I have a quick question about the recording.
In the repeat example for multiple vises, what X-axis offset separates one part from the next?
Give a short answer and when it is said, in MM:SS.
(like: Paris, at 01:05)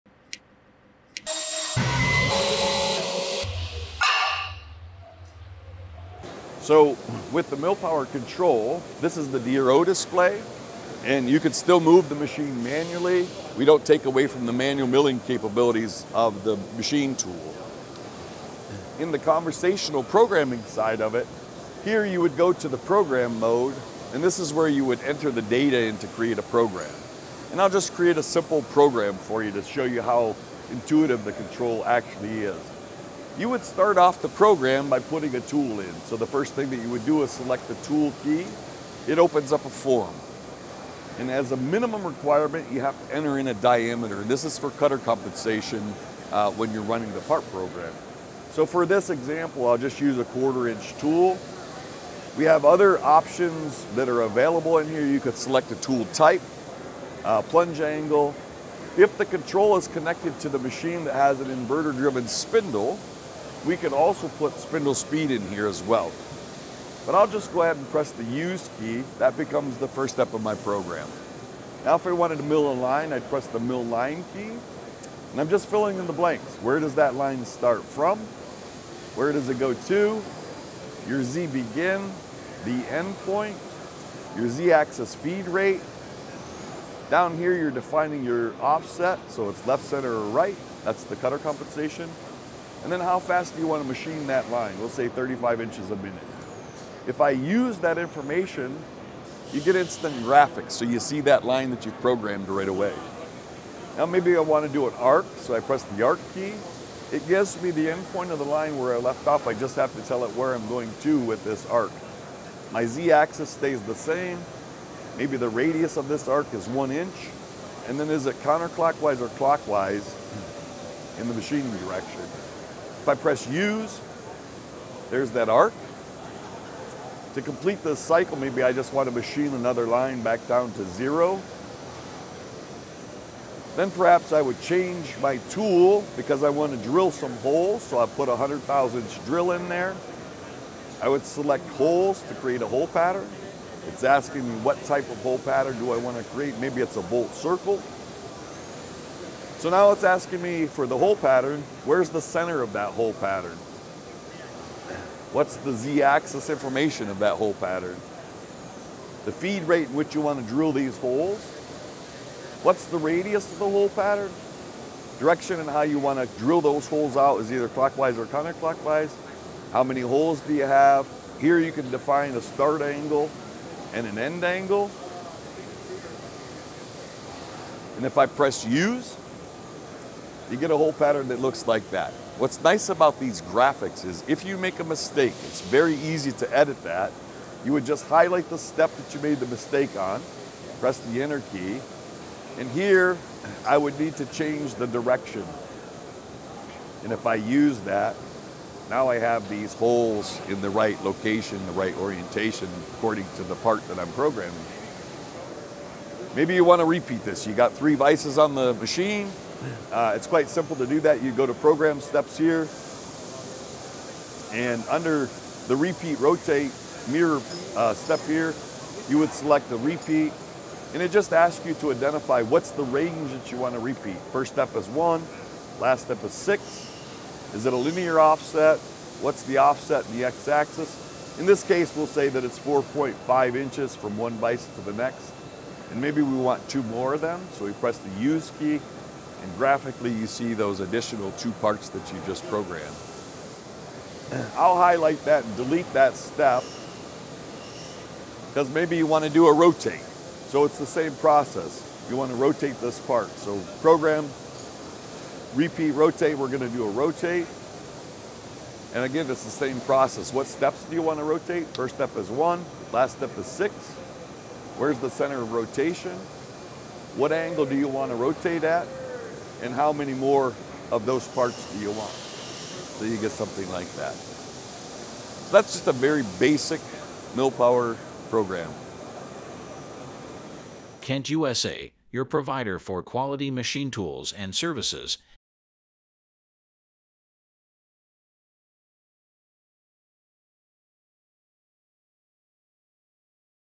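4.5 inches, at 03:52.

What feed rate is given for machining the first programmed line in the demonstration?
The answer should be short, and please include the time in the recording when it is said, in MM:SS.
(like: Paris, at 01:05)
35 inches a minute, at 01:35.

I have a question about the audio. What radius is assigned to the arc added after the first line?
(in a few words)
one inch.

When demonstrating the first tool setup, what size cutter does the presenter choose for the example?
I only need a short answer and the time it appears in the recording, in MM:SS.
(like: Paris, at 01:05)
quarter inch, at 00:50.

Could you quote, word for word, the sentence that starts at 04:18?
And again, it's the same process.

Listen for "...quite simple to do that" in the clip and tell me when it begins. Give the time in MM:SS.
03:30.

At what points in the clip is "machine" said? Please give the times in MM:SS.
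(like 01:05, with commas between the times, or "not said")
00:12, 00:16, 01:00, 01:33, 02:01, 02:09, 03:28, 04:43.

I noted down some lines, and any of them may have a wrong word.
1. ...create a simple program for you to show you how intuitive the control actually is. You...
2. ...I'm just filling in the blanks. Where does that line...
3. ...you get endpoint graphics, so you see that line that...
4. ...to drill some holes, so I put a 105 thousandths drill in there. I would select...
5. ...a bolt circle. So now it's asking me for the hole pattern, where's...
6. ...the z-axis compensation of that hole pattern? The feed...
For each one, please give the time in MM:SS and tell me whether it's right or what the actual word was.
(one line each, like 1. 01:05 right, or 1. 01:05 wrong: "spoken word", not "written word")
1. 00:27 right
2. 01:15 right
3. 01:39 wrong: "instant", not "endpoint"
4. 02:16 wrong: "100", not "105"
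5. 02:26 right
6. 02:35 wrong: "information", not "compensation".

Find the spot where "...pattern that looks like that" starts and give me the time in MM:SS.
03:00.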